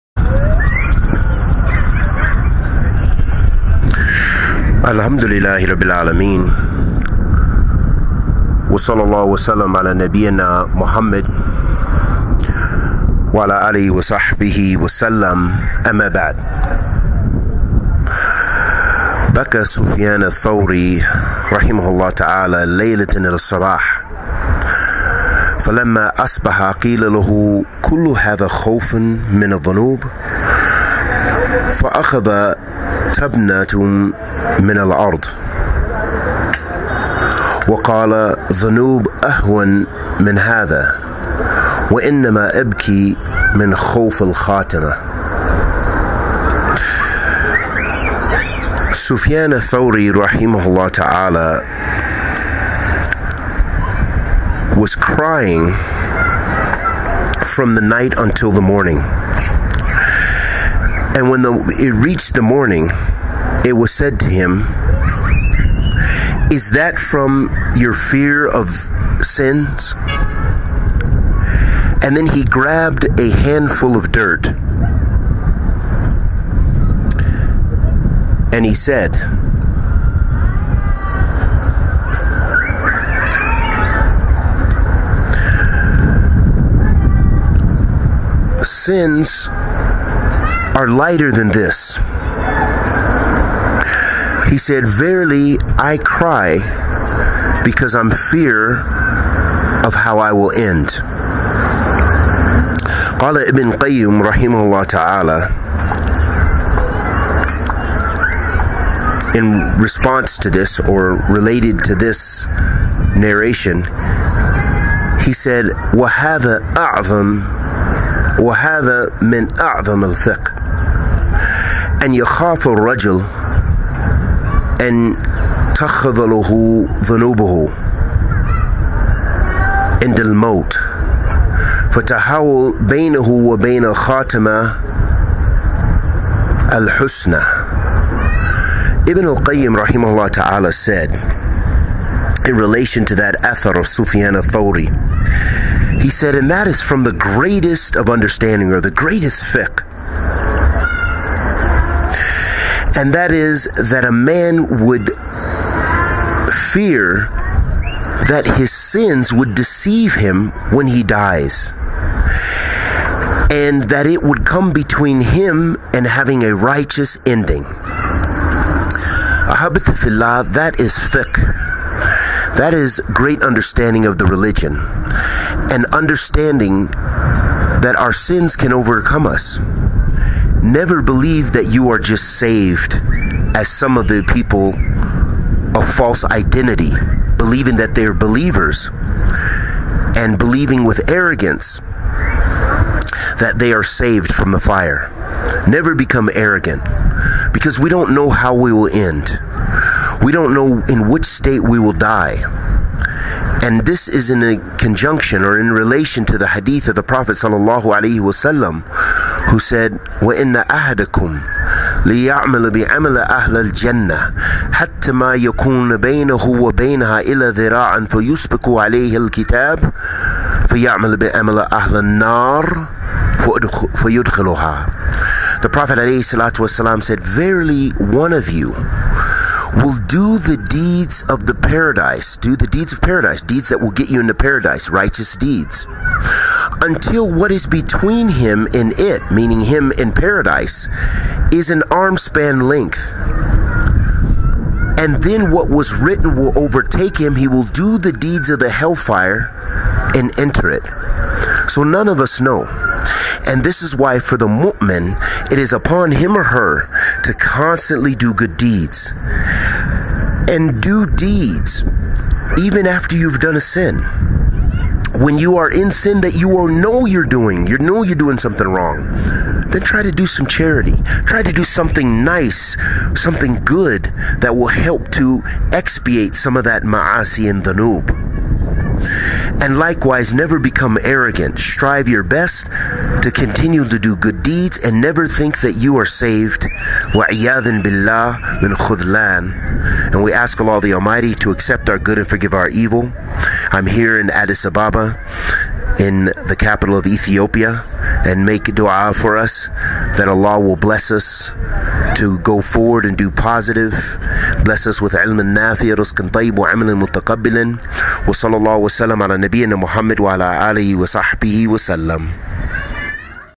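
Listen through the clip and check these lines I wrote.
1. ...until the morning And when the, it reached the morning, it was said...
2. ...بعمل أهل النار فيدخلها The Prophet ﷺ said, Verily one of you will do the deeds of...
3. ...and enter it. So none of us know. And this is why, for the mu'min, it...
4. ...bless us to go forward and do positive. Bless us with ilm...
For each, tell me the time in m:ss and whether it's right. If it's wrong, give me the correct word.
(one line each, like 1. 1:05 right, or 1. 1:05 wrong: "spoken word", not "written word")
1. 0:58 right
2. 3:41 right
3. 4:10 right
4. 5:00 right.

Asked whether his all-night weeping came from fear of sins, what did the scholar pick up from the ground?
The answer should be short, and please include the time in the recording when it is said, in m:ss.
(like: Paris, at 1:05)
a handful of dirt, at 1:13.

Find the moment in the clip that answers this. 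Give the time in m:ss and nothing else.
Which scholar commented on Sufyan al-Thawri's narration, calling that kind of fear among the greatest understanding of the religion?
2:19.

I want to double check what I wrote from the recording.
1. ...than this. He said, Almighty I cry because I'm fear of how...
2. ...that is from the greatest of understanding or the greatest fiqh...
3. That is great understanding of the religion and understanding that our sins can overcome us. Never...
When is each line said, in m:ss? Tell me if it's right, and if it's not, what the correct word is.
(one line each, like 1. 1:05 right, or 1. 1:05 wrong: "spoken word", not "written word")
1. 1:31 wrong: "Verily", not "Almighty"
2. 2:26 right
3. 2:52 right.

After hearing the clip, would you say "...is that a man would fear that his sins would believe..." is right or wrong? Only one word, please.
wrong.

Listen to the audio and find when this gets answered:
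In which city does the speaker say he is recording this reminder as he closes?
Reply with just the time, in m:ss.
4:54.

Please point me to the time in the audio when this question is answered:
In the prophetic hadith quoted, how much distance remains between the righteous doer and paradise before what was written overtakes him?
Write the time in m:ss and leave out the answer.
4:01.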